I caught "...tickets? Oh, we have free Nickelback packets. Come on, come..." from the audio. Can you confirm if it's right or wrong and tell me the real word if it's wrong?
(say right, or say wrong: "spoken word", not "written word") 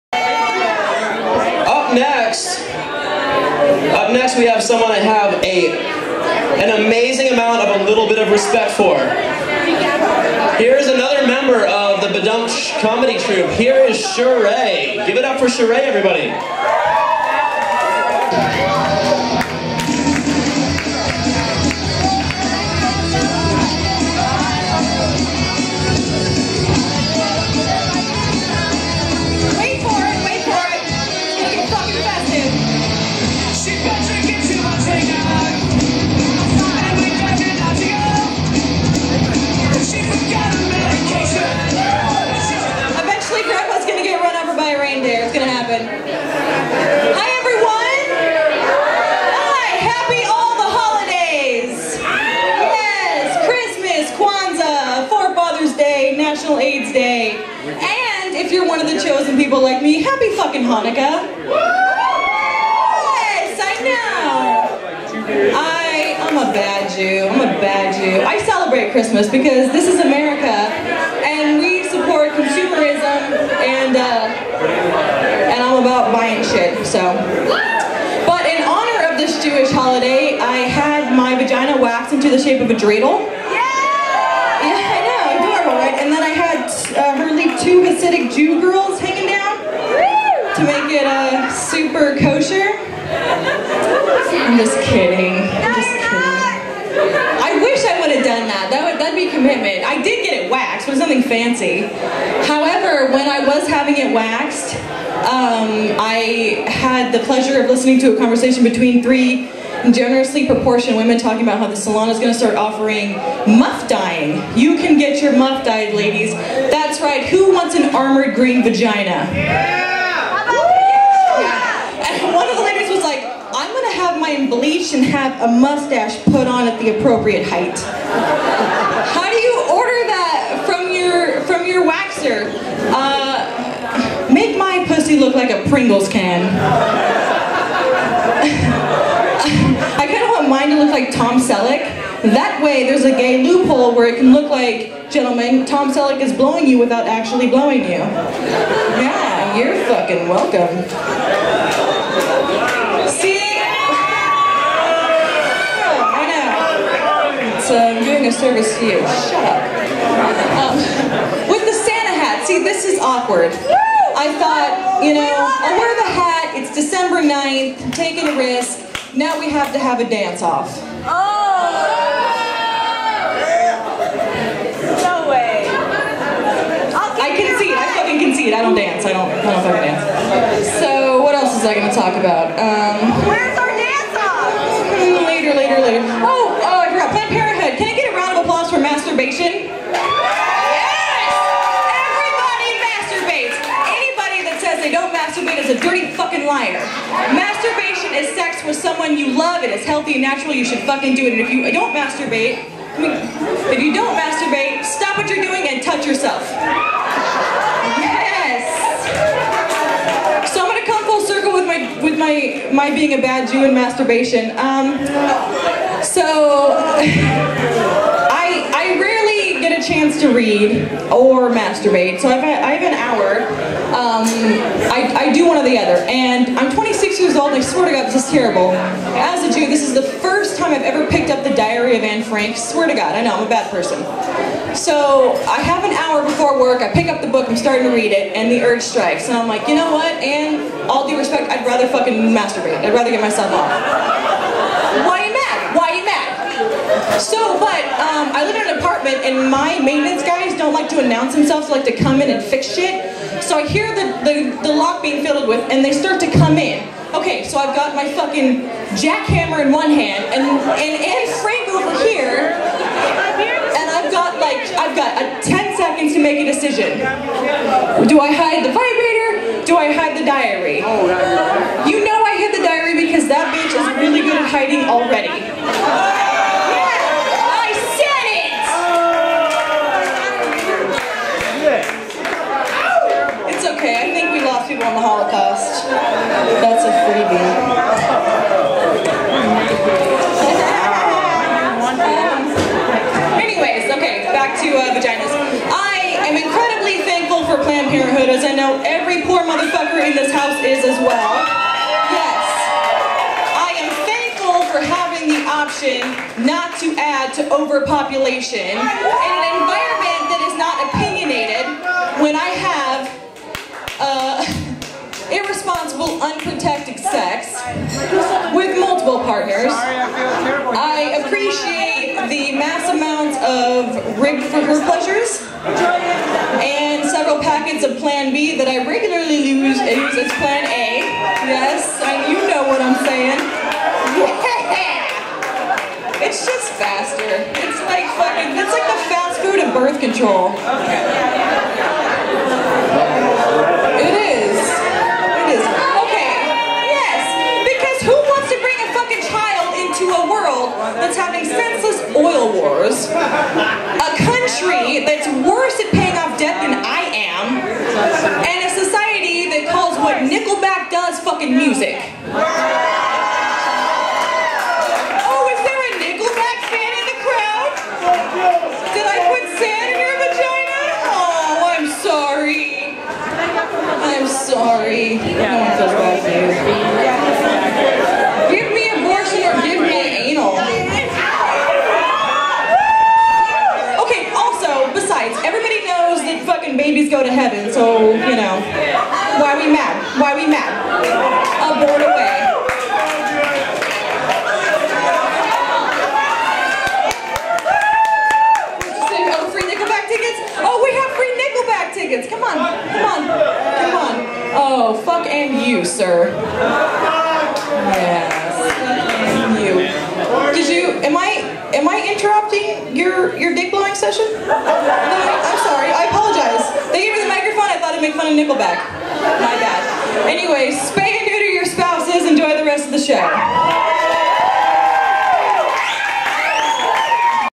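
wrong: "tickets", not "packets".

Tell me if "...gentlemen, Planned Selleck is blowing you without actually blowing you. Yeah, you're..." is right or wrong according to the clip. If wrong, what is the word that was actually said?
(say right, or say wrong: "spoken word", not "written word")
wrong: "Tom", not "Planned".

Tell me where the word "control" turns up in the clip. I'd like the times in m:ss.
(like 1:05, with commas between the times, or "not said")
5:39.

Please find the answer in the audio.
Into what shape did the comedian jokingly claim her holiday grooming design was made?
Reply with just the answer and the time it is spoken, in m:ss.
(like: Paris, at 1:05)
a dreidel, at 1:22.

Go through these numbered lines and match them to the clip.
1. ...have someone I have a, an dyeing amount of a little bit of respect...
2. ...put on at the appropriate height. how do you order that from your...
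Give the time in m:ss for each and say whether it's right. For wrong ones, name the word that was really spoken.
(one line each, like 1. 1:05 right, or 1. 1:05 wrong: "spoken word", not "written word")
1. 0:04 wrong: "amazing", not "dyeing"
2. 2:06 right.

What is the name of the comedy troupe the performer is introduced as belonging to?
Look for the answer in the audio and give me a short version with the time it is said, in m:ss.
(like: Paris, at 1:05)
Ba-Dum-Chh, at 0:12.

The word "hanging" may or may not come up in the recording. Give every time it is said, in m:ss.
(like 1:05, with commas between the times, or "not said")
1:28.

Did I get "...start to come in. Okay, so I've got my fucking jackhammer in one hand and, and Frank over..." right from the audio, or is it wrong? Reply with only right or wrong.
right.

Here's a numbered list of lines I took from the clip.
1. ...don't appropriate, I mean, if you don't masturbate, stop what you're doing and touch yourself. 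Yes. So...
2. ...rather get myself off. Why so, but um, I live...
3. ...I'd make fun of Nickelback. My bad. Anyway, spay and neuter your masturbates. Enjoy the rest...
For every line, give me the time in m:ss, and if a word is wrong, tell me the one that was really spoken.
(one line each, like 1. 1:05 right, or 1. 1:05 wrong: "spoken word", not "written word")
1. 3:21 wrong: "masturbate", not "appropriate"
2. 4:02 right
3. 6:57 wrong: "spouses", not "masturbates".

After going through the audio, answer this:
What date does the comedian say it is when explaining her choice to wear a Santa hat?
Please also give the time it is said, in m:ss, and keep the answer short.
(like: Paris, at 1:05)
December 9th, at 2:46.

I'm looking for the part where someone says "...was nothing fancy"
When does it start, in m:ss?
1:40.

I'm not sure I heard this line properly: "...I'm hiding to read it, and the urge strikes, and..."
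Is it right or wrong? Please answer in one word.
wrong.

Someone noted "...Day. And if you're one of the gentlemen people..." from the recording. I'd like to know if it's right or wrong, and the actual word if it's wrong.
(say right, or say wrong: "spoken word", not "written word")
wrong: "chosen", not "gentlemen".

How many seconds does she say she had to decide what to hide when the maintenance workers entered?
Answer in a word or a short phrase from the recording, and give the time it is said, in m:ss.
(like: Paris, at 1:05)
10, at 4:25.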